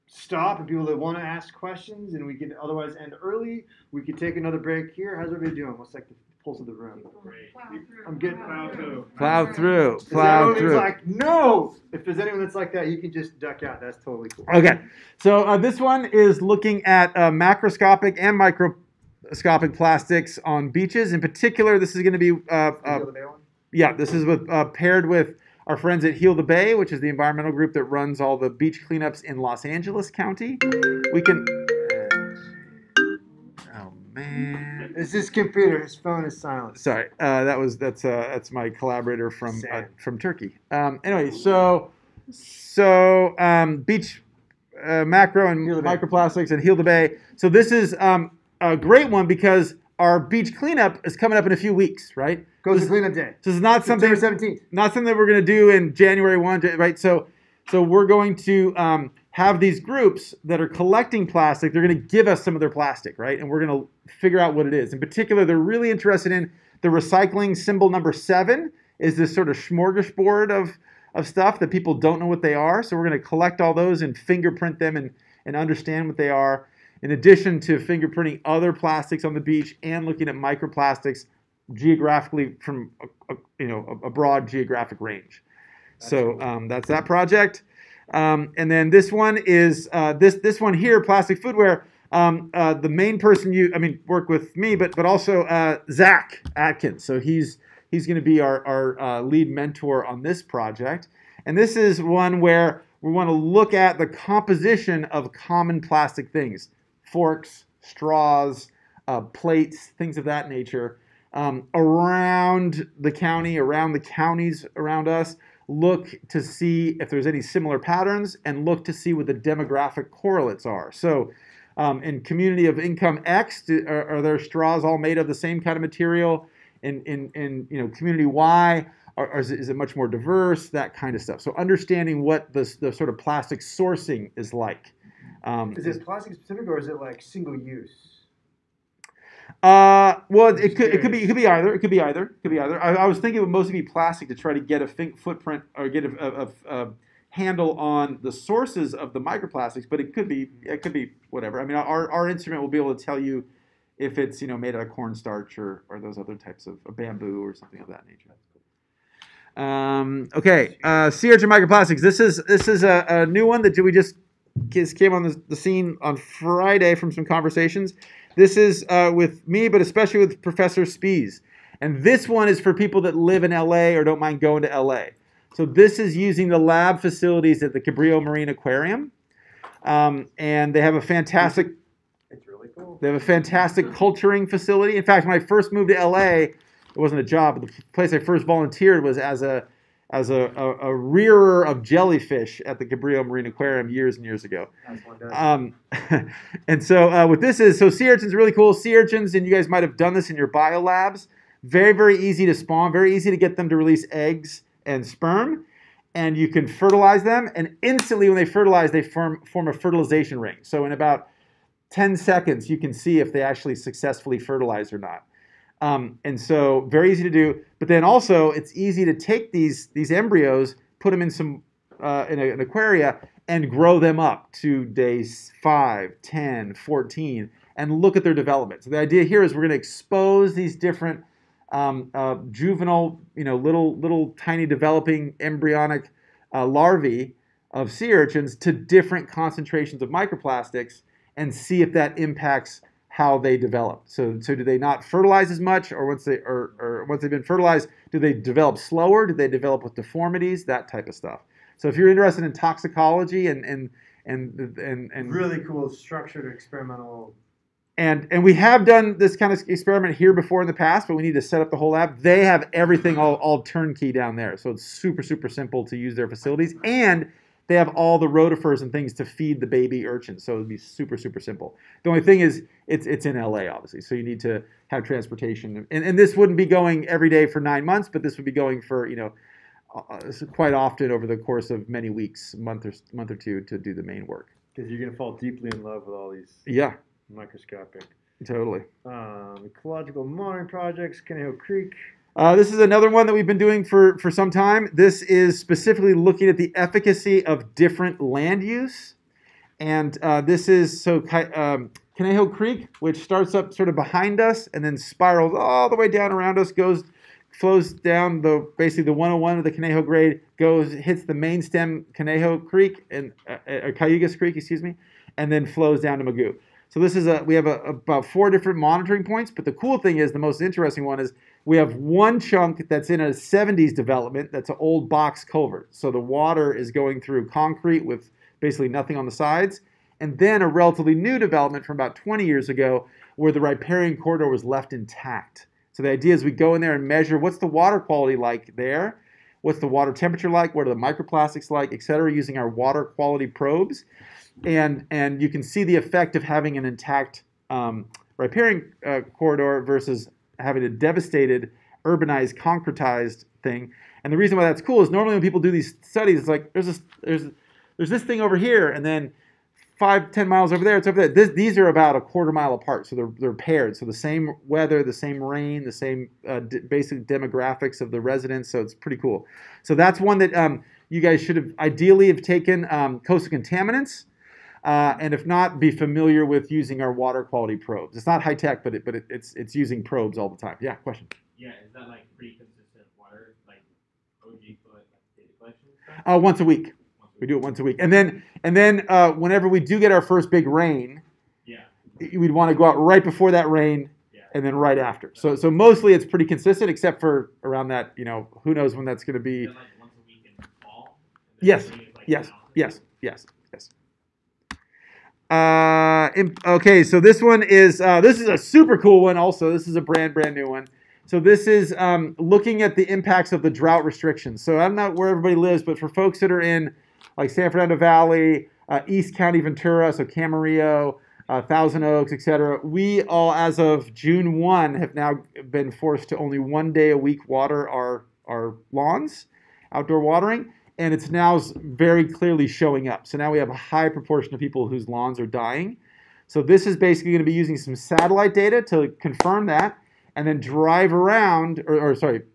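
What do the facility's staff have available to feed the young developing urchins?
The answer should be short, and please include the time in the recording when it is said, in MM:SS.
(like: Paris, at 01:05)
rotifers, at 04:28.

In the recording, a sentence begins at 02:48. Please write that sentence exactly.
This is uh, with me, but especially with Professor Spees.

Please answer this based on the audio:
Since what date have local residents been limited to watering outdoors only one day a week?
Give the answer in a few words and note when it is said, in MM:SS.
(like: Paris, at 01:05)
June 1, at 07:04.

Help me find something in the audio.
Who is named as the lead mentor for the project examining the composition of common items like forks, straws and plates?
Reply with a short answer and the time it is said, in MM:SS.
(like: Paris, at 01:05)
Zach Atkins, at 01:35.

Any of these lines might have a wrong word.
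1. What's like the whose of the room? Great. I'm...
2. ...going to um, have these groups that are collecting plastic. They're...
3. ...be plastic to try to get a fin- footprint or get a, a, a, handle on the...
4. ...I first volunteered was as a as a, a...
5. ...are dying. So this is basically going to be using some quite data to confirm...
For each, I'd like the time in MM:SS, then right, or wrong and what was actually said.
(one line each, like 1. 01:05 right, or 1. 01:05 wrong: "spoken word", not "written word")
1. 00:05 wrong: "pulse", not "whose"
2. 00:58 right
3. 02:23 right
4. 03:08 right
5. 07:15 wrong: "satellite", not "quite".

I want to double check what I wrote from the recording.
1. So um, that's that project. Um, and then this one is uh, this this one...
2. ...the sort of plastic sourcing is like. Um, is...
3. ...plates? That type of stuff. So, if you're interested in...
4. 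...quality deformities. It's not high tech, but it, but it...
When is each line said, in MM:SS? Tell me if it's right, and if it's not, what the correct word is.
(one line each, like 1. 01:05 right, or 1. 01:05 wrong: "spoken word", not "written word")
1. 01:25 right
2. 02:12 right
3. 04:09 wrong: "deformities", not "plates"
4. 06:17 wrong: "probes", not "deformities".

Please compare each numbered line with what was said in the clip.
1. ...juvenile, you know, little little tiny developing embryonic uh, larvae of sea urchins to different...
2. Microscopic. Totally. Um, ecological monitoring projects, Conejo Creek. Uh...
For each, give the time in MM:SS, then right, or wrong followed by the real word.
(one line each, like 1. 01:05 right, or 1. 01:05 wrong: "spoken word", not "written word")
1. 03:52 right
2. 04:47 right.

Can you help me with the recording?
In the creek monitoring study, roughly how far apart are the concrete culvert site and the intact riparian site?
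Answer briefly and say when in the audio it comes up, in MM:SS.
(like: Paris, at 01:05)
a quarter mile, at 06:02.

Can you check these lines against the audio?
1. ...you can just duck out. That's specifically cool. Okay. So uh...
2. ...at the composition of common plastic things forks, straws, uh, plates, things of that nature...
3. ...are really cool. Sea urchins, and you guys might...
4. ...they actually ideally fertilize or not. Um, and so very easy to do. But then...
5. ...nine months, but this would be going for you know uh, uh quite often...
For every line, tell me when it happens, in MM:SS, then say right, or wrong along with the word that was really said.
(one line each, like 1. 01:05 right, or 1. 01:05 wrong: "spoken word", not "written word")
1. 00:12 wrong: "totally", not "specifically"
2. 01:43 right
3. 03:18 right
4. 03:33 wrong: "successfully", not "ideally"
5. 04:37 right.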